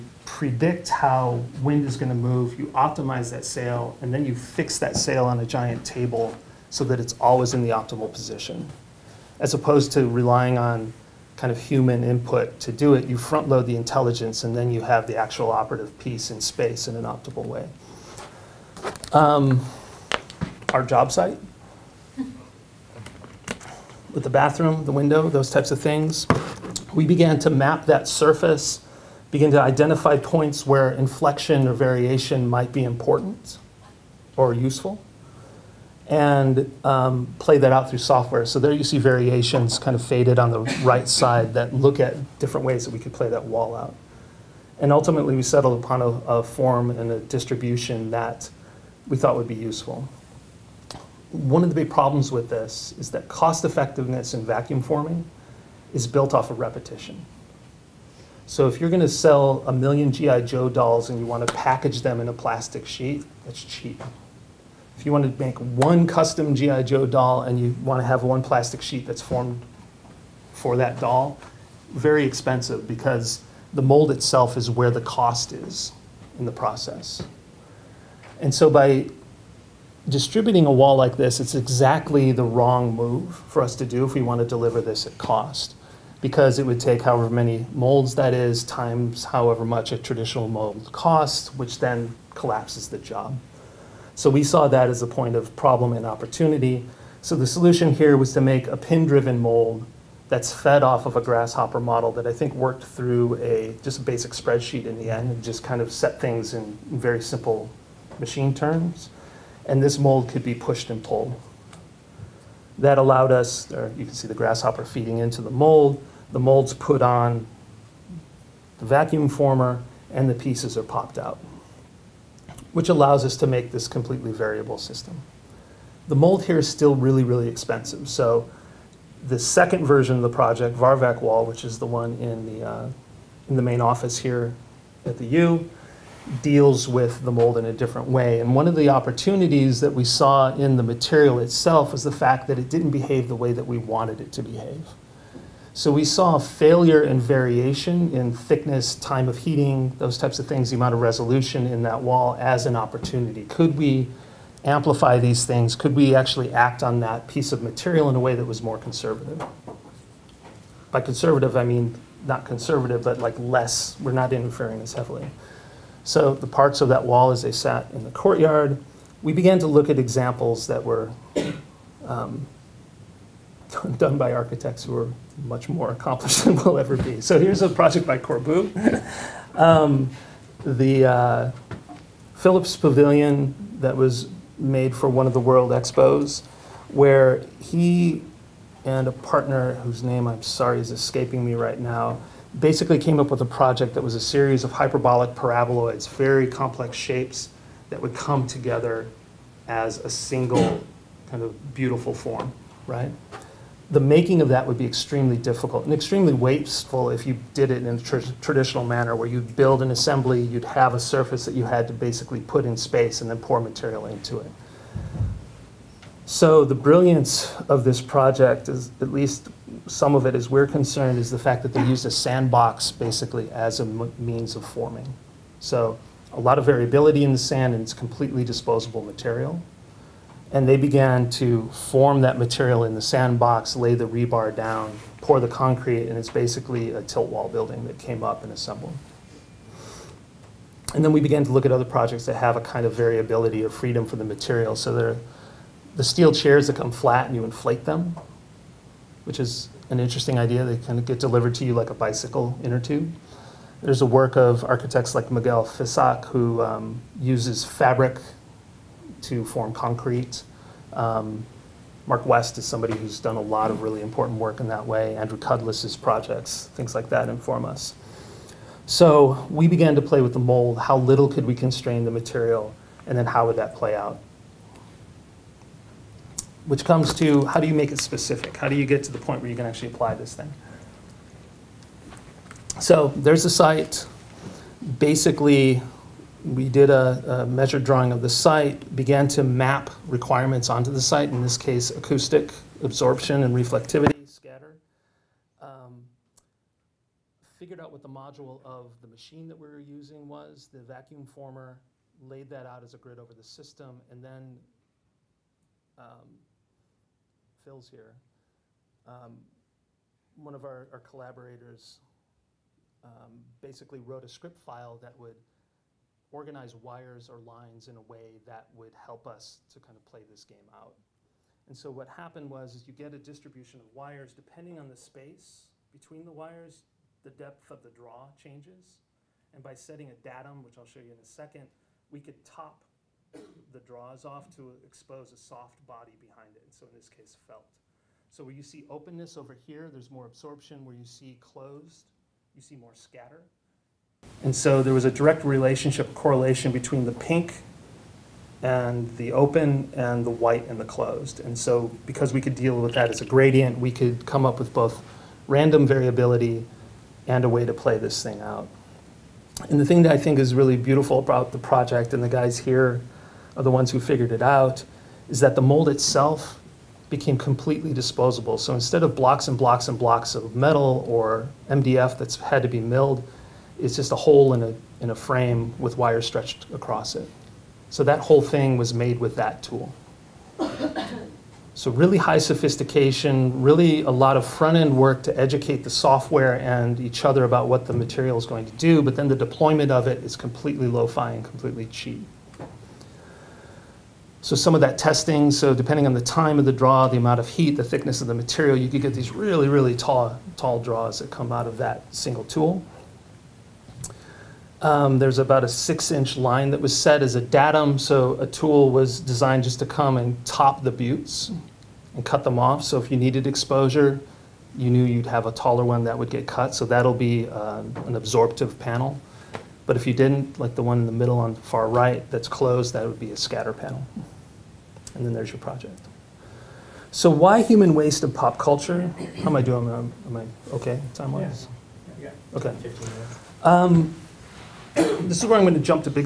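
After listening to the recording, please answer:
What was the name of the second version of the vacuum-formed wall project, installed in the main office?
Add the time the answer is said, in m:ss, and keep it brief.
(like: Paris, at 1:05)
Varvac Wall, at 2:10.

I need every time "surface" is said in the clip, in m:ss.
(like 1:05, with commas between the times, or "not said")
0:28, 3:30.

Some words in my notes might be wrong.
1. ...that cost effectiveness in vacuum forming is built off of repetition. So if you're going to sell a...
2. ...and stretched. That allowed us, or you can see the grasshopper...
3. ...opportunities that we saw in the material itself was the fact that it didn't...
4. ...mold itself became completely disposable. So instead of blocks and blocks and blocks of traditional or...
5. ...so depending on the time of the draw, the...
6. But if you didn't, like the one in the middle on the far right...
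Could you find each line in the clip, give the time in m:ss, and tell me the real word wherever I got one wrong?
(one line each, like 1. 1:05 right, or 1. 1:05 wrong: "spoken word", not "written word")
1. 0:53 right
2. 1:50 wrong: "pulled", not "stretched"
3. 2:18 right
4. 6:05 wrong: "metal", not "traditional"
5. 6:35 right
6. 6:59 right.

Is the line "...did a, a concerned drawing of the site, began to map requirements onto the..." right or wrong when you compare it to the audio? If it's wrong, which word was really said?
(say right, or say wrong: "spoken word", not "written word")
wrong: "measured", not "concerned".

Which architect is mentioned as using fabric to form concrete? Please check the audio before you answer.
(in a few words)
Miguel Fisac.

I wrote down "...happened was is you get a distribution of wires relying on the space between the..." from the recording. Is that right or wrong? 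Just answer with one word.
wrong.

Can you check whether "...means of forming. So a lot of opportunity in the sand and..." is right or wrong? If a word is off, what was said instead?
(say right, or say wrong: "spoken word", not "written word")
wrong: "variability", not "opportunity".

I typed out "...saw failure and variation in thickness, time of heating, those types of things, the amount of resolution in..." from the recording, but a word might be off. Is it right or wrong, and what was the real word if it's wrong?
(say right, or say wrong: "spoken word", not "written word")
right.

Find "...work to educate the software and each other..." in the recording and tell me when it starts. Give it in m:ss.
6:24.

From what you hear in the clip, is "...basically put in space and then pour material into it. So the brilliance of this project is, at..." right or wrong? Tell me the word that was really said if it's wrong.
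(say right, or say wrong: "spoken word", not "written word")
right.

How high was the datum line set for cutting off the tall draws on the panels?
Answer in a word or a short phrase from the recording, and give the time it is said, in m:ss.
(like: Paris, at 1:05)
6 inches, at 6:45.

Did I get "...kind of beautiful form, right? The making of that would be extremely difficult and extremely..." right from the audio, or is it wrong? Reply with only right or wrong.
right.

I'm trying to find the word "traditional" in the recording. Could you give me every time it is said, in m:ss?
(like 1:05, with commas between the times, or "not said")
1:29, 3:28.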